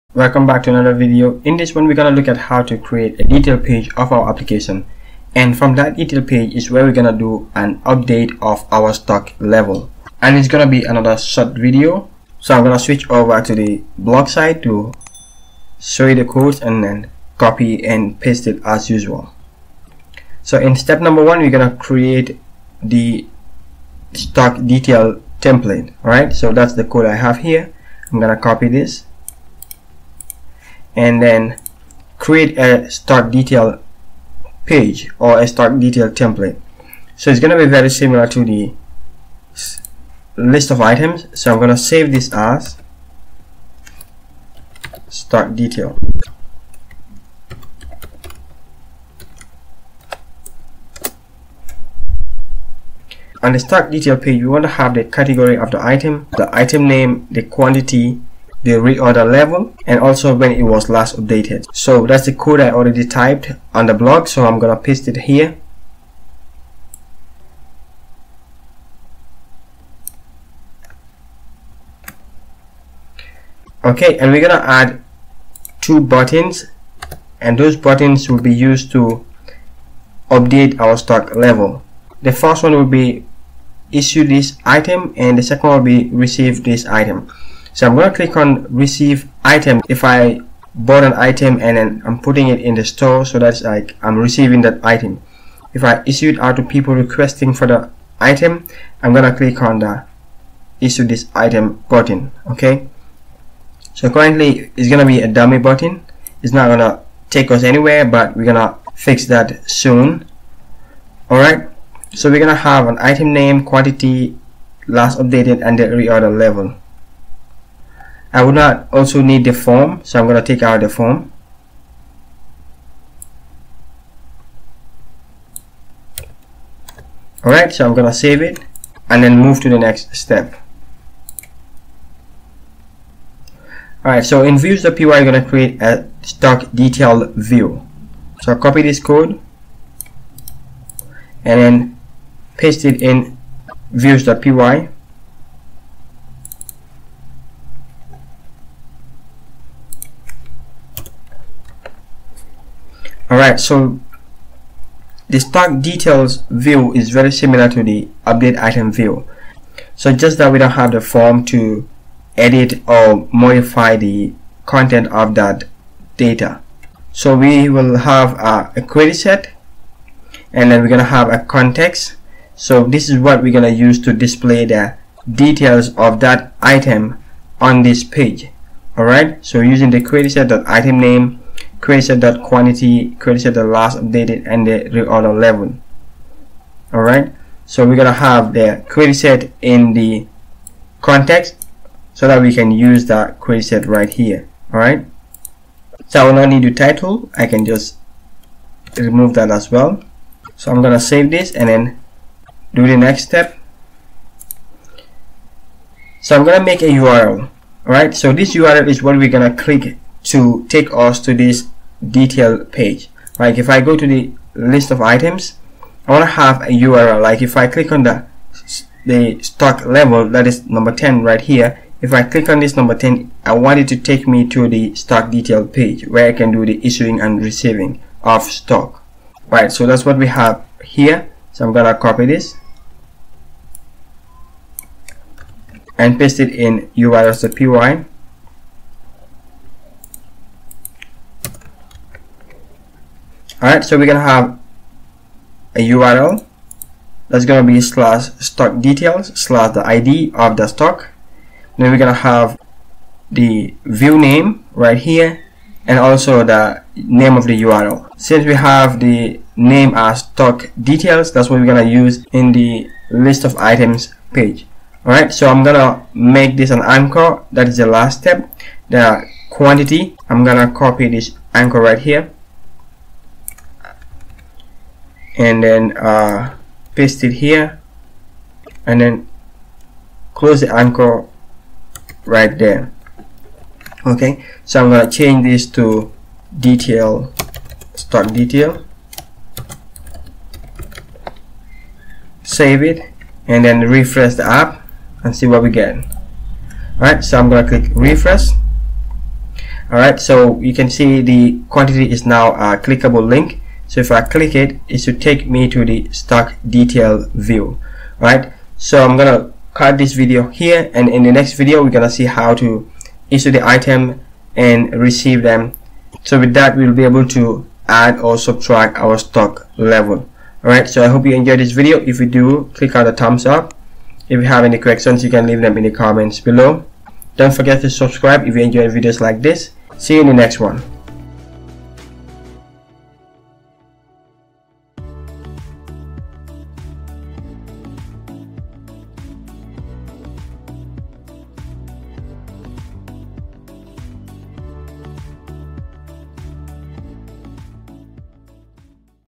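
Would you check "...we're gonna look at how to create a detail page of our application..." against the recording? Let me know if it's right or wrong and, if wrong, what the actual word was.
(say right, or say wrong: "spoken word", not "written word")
right.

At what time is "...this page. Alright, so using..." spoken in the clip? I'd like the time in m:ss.
2:57.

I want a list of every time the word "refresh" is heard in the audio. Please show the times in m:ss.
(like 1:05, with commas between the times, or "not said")
4:53, 4:57.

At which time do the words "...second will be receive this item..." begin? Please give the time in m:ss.
1:25.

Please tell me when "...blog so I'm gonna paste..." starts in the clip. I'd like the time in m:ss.
1:03.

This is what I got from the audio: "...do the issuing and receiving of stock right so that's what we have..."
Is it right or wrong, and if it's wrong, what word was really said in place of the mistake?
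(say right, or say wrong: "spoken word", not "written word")
right.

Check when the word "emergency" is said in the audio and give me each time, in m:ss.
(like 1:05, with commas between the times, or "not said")
not said.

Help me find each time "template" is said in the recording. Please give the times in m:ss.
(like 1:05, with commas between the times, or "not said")
0:25, 0:36.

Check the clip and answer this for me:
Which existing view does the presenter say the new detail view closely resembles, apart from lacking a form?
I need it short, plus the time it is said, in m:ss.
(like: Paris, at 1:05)
update item view, at 2:38.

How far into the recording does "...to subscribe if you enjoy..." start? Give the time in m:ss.
5:27.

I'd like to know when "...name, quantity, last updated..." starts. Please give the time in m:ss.
1:53.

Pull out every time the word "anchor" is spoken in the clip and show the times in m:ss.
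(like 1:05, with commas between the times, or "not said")
4:26, 4:31, 4:40.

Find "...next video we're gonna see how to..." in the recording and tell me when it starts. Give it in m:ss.
5:11.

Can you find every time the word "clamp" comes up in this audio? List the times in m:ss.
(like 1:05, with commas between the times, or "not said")
not said.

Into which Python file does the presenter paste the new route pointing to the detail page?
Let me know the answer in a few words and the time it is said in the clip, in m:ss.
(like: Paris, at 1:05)
URL.py, at 3:56.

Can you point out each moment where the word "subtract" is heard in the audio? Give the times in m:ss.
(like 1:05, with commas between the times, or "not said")
5:18.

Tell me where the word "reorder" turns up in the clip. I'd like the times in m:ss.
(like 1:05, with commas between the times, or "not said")
0:58, 1:55, 3:04.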